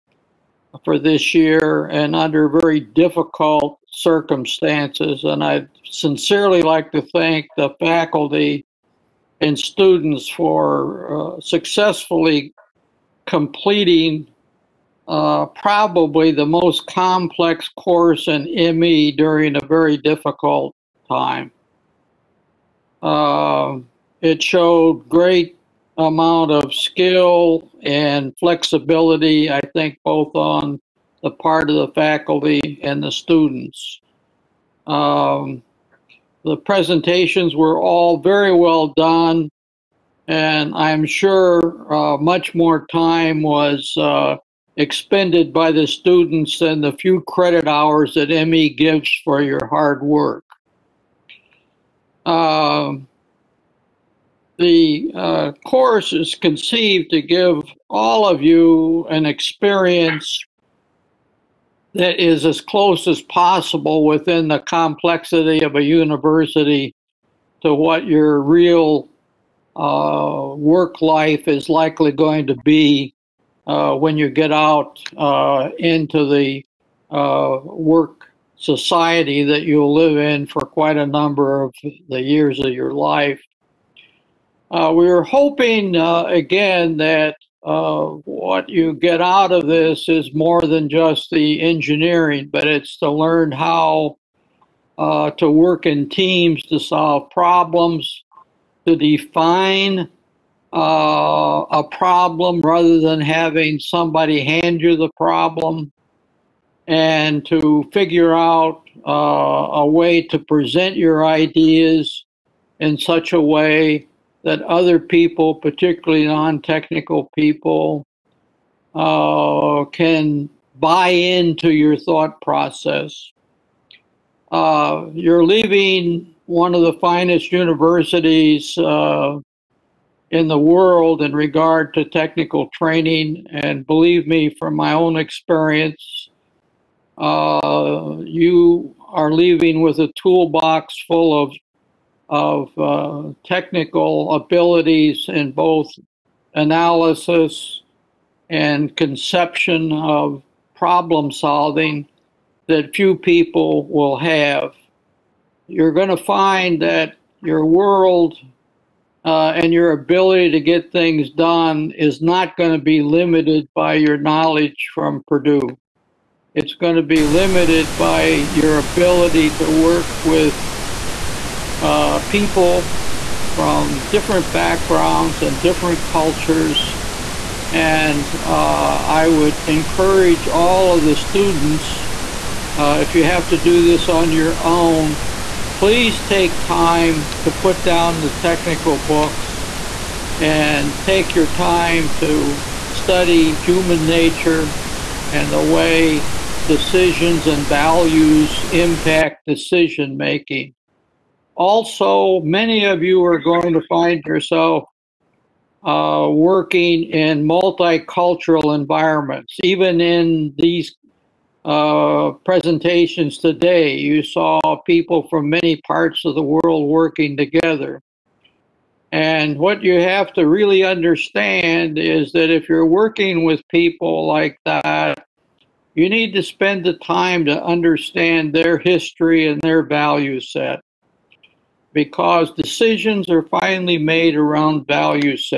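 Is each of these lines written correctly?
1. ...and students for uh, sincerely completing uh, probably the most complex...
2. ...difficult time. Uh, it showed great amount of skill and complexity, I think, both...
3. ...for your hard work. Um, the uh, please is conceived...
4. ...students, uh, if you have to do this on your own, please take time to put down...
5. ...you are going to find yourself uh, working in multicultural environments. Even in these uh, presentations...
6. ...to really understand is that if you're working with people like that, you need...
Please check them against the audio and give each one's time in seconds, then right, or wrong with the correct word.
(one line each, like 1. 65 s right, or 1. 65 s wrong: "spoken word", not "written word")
1. 9 s wrong: "successfully", not "sincerely"
2. 19 s wrong: "flexibility", not "complexity"
3. 49 s wrong: "course", not "please"
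4. 181 s right
5. 203 s right
6. 220 s right.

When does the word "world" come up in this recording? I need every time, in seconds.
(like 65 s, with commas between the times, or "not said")
130 s, 157 s, 216 s.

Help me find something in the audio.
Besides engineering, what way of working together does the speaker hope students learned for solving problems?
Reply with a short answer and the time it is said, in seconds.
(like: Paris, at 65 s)
teams, at 96 s.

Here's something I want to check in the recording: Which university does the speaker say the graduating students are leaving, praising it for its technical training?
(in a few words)
Purdue.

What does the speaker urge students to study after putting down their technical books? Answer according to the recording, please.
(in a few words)
human nature.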